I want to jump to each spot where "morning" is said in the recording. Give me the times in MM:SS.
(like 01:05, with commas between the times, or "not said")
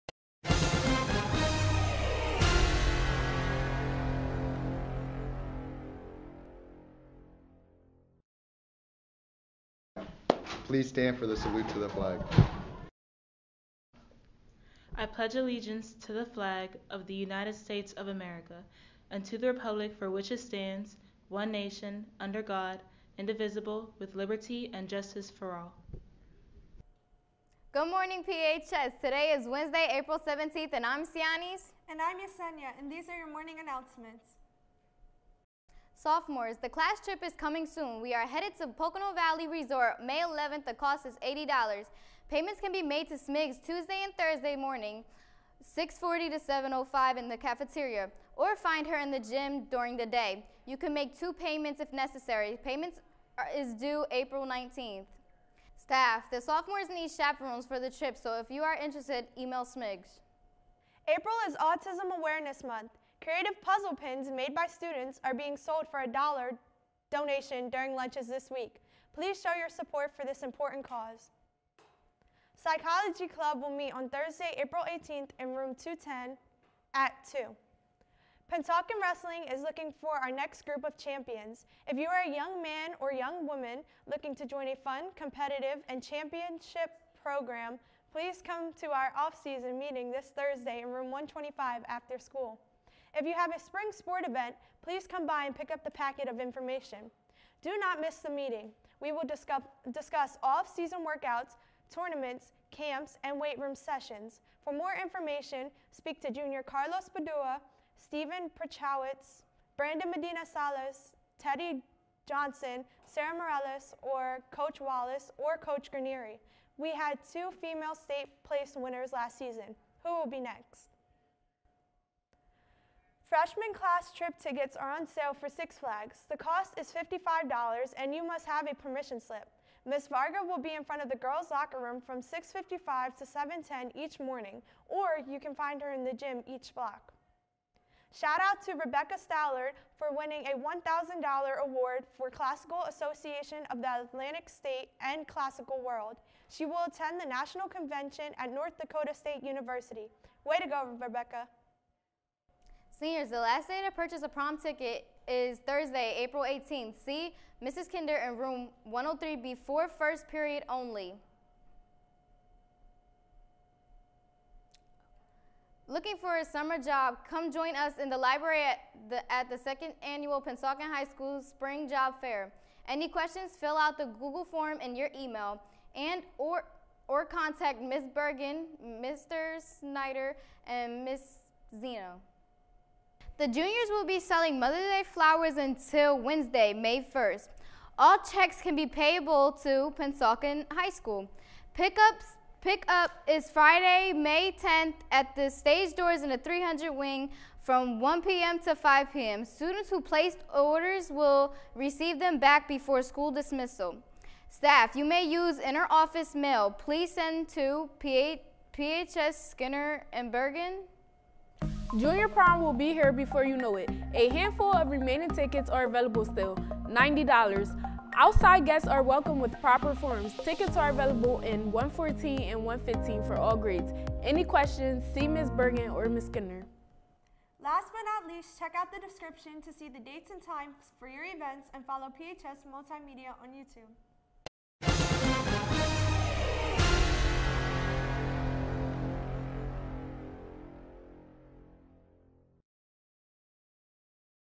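00:27, 00:33, 00:44, 02:14.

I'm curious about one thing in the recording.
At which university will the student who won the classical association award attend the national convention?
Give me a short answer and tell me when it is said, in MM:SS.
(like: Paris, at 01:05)
North Dakota State University, at 02:28.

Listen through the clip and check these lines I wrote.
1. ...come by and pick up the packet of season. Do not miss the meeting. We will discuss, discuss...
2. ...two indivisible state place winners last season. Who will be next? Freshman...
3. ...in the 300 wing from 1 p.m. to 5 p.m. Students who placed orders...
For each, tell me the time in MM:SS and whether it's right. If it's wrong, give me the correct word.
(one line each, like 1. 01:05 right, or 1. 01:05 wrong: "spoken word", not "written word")
1. 01:35 wrong: "information", not "season"
2. 01:57 wrong: "female", not "indivisible"
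3. 03:16 right.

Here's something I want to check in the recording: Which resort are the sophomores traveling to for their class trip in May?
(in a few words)
Pocono Valley Resort.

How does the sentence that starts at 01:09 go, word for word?
Please show your support for this important cause.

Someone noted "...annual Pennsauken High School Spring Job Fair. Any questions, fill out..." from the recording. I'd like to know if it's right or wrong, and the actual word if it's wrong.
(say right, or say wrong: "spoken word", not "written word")
right.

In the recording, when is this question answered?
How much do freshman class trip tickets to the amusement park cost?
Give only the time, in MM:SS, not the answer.
02:06.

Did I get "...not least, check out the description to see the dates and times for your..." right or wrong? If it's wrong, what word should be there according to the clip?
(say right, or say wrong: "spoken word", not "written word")
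right.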